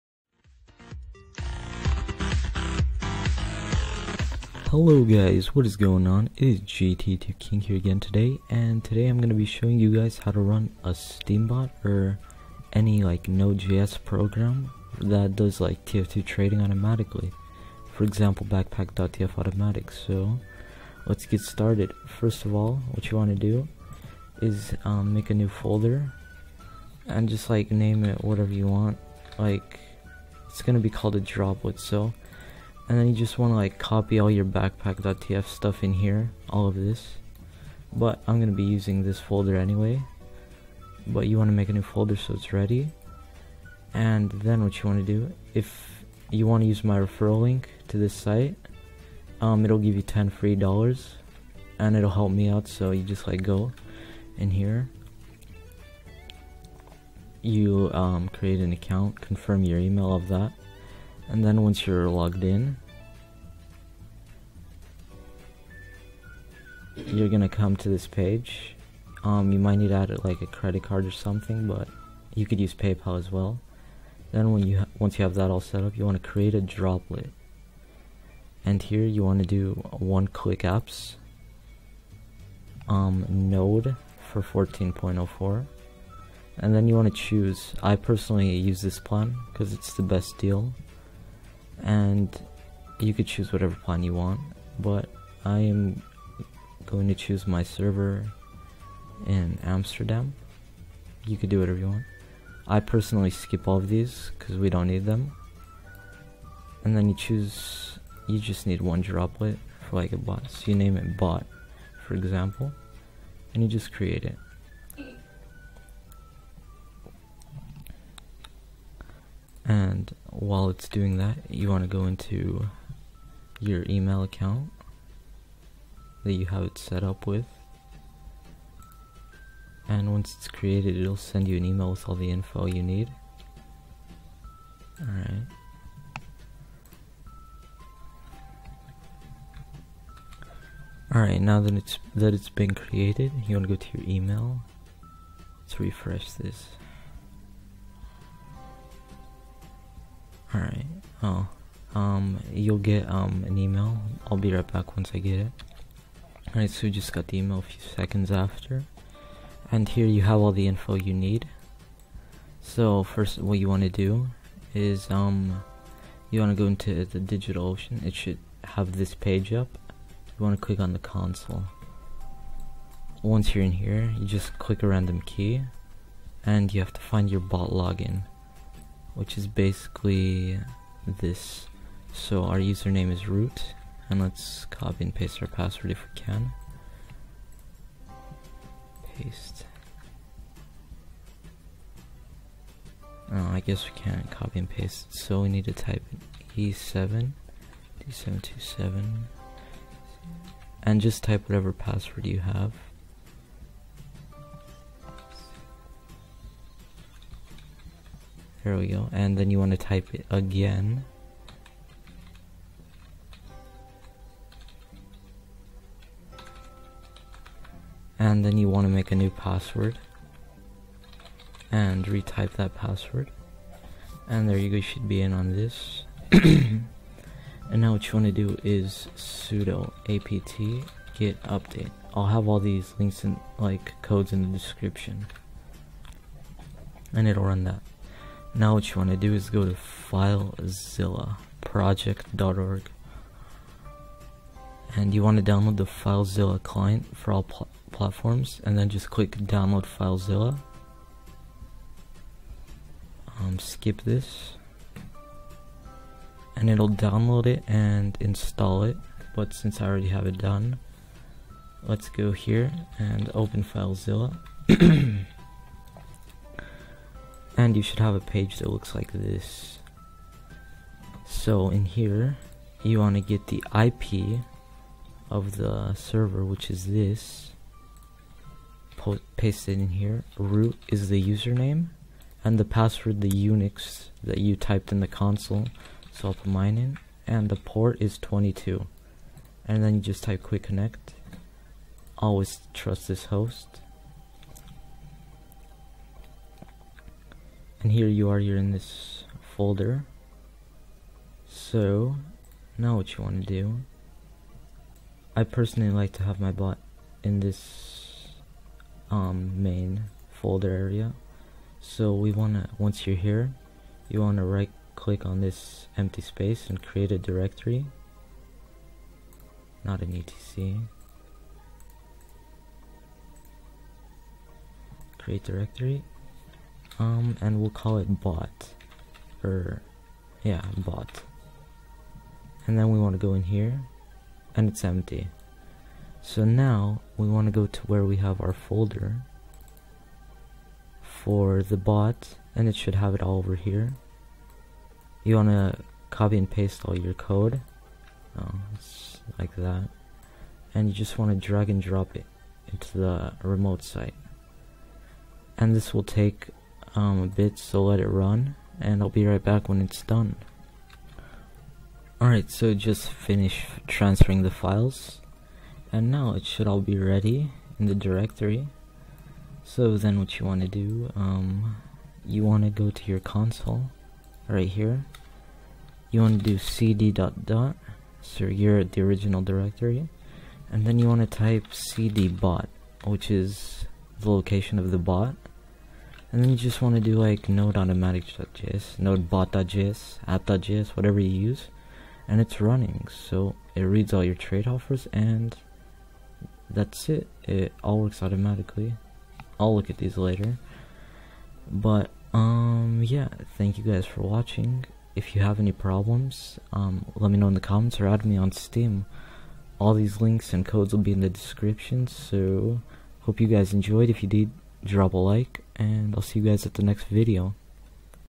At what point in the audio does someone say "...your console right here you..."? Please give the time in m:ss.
6:13.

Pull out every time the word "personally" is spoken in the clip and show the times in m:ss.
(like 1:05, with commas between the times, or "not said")
1:27, 1:42, 5:05.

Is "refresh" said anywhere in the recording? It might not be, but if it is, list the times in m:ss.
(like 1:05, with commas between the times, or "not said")
2:25.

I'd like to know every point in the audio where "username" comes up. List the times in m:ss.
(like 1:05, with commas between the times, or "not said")
3:02, 4:41.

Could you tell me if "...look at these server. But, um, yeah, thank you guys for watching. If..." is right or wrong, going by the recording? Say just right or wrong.
wrong.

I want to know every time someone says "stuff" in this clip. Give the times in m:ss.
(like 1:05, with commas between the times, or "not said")
0:35.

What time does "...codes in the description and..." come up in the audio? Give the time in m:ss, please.
3:54.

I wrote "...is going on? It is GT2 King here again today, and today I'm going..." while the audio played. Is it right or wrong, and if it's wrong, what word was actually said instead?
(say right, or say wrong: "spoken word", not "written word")
right.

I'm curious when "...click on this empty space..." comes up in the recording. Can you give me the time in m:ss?
5:14.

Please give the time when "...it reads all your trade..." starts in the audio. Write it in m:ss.
6:33.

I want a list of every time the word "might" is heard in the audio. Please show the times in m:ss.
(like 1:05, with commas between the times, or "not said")
1:09.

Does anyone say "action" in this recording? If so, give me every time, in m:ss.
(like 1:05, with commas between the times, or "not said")
not said.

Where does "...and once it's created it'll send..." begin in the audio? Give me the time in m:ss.
2:09.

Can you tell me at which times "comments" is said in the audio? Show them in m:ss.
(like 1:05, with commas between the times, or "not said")
6:47.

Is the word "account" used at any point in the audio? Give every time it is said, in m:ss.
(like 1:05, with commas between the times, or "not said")
0:58, 2:04.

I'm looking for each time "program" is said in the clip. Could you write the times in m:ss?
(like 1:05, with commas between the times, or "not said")
0:14.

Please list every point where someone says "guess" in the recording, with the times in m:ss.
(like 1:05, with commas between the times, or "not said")
3:13.